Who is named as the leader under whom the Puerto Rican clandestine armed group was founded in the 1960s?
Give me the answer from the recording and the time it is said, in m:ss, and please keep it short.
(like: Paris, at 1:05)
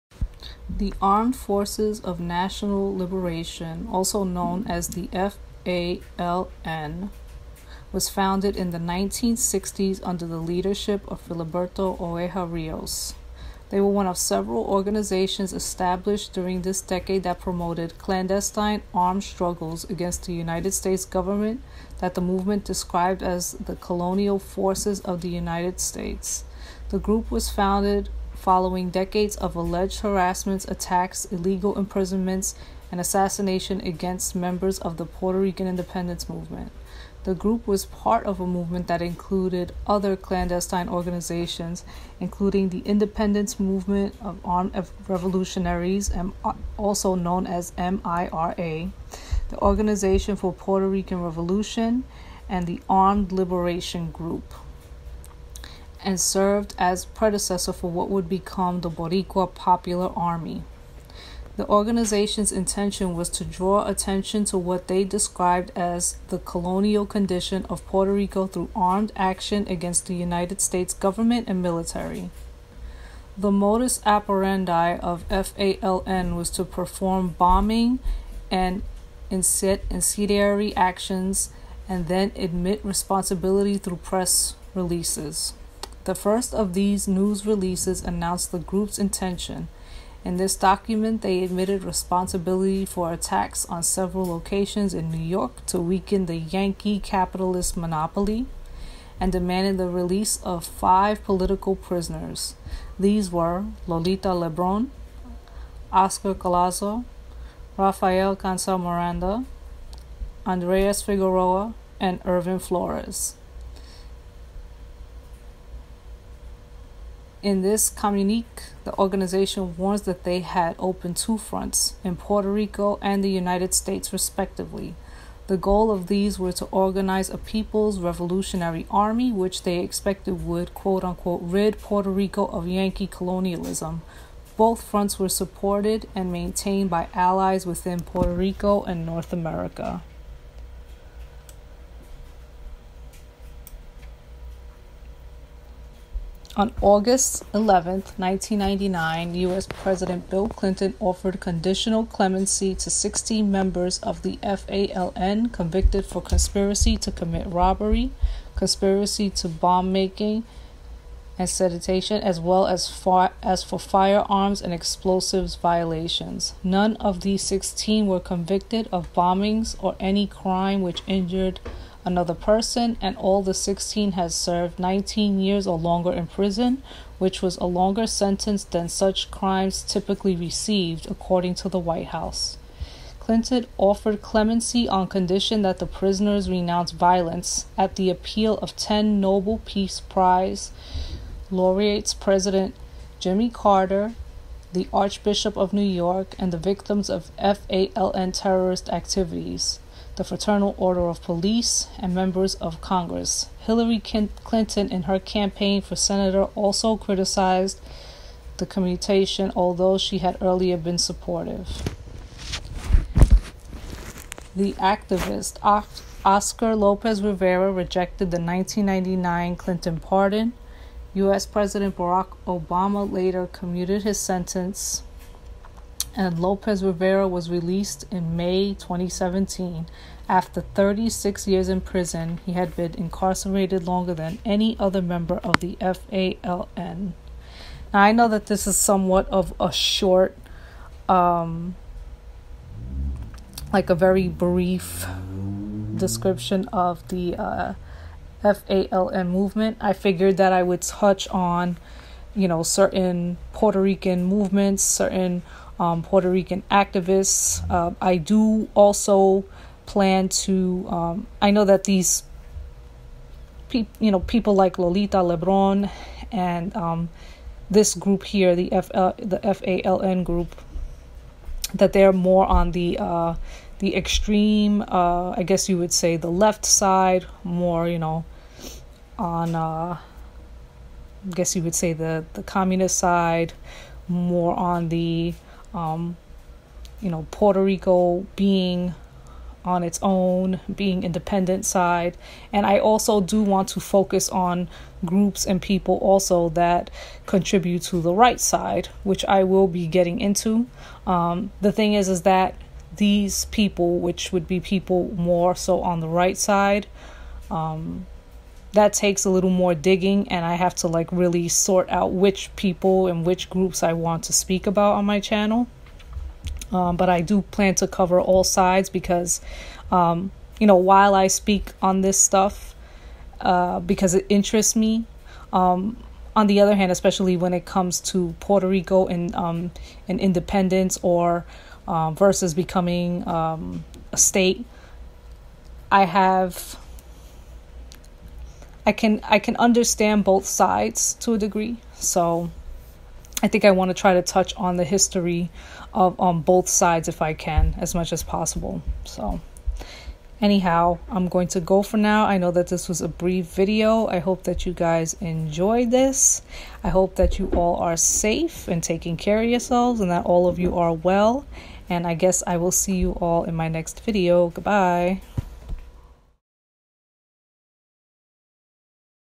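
Filiberto Ojeda Rios, at 0:11.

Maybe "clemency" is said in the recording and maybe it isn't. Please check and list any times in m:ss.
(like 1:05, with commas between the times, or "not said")
2:32, 3:04.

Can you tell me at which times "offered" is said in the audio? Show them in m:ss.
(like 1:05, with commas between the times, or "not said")
2:30, 3:03.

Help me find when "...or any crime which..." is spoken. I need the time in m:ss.
2:49.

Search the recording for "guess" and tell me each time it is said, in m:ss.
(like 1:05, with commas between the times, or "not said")
4:35, 4:41, 6:02.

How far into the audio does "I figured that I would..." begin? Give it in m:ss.
4:09.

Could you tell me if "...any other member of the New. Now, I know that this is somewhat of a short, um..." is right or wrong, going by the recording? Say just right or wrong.
wrong.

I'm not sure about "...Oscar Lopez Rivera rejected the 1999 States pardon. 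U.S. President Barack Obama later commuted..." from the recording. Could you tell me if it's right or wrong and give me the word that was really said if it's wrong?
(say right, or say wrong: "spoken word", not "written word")
wrong: "Clinton", not "States".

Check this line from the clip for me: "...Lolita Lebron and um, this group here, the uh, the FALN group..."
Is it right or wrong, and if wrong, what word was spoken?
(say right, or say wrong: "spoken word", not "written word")
right.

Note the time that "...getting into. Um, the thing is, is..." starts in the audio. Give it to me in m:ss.
4:59.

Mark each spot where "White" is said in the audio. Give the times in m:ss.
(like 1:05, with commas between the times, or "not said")
3:01.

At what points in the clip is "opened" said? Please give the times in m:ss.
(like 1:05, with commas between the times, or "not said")
2:00.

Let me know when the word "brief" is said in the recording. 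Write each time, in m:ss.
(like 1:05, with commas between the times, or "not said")
4:04, 5:53.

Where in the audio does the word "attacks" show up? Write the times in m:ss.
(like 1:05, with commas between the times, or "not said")
0:30, 1:33.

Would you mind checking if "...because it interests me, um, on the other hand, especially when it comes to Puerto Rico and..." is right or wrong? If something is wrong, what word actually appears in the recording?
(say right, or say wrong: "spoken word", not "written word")
right.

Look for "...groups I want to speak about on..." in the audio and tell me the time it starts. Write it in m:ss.
5:13.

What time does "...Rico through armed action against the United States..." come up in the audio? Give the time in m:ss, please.
1:08.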